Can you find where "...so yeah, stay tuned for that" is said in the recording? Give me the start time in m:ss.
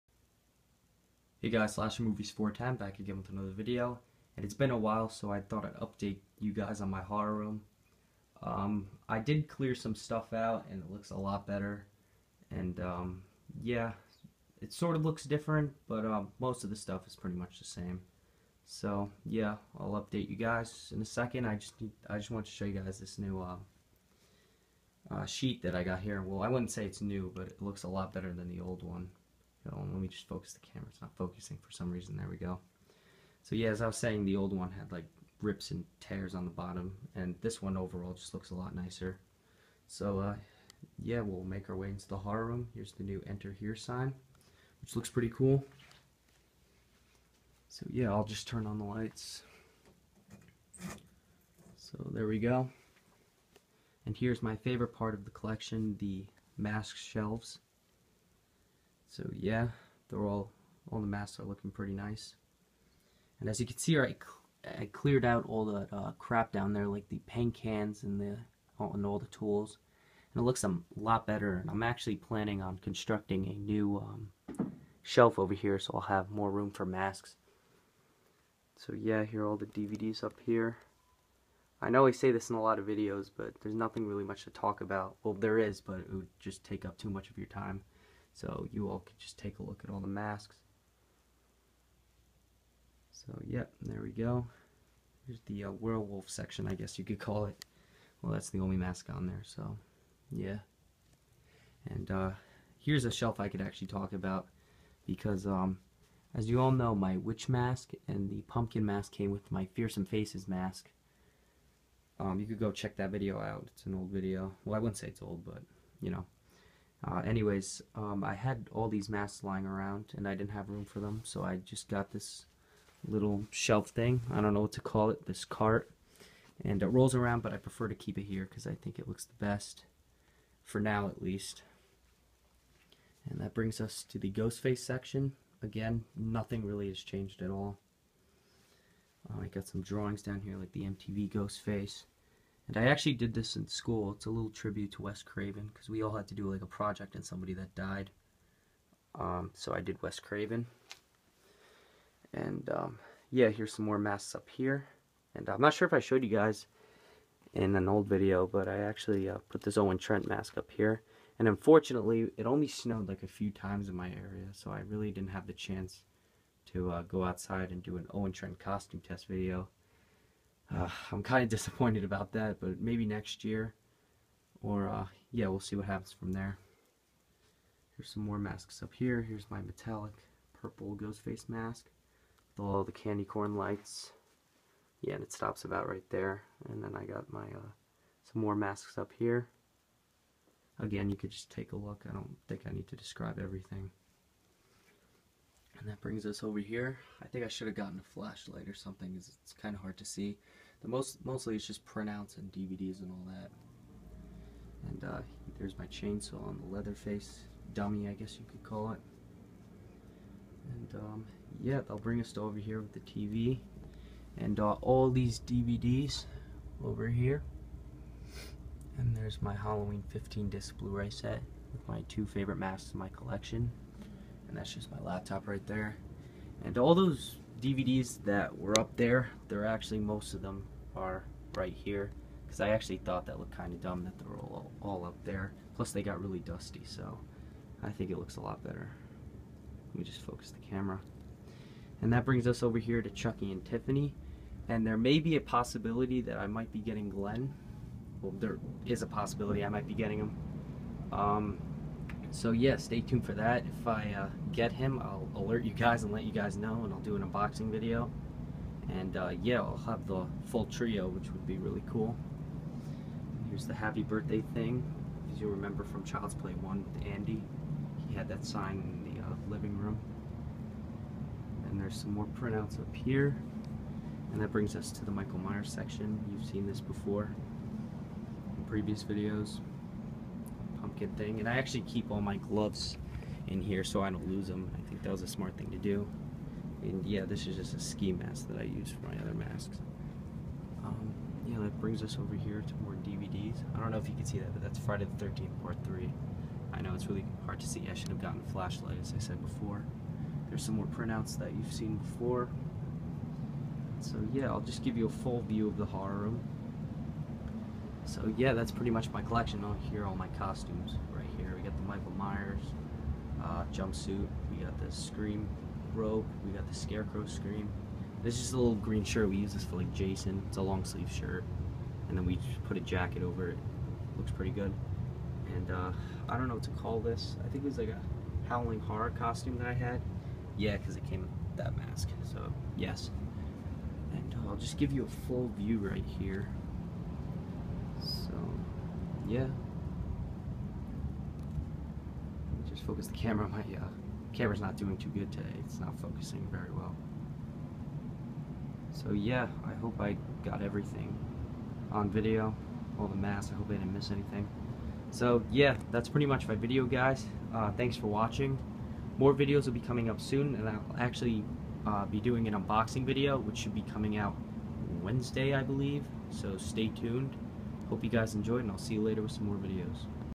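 4:12.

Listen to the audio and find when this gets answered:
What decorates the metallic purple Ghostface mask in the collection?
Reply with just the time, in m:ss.
3:02.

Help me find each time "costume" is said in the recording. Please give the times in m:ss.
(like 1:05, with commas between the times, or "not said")
2:48, 5:10, 5:29.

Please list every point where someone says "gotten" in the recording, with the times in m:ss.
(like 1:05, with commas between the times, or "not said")
3:17, 4:58.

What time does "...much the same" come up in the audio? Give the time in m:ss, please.
0:17.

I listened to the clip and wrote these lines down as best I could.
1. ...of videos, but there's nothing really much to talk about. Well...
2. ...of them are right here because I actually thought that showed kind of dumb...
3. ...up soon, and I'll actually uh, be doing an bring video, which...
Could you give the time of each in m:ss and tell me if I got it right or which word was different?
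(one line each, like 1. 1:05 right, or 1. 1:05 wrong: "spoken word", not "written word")
1. 1:22 right
2. 3:50 wrong: "looked", not "showed"
3. 6:00 wrong: "unboxing", not "bring".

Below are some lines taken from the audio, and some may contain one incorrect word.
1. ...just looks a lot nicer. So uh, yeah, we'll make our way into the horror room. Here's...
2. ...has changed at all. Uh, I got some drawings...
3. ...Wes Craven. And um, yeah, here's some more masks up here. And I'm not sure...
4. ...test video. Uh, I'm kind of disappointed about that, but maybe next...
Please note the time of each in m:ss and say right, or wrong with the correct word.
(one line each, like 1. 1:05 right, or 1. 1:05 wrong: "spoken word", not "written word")
1. 0:38 right
2. 2:16 right
3. 2:30 right
4. 2:49 right.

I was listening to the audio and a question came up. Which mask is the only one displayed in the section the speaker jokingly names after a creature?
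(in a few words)
Werewolf.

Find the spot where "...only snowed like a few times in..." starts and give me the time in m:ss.
2:42.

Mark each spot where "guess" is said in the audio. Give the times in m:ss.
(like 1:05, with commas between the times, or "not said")
1:36, 3:28.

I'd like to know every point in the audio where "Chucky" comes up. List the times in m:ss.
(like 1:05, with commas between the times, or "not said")
4:03.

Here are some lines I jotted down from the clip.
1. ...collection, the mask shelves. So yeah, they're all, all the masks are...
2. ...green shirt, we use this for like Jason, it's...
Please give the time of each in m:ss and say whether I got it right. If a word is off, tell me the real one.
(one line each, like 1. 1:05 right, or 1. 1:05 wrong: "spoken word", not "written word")
1. 0:55 right
2. 5:18 right.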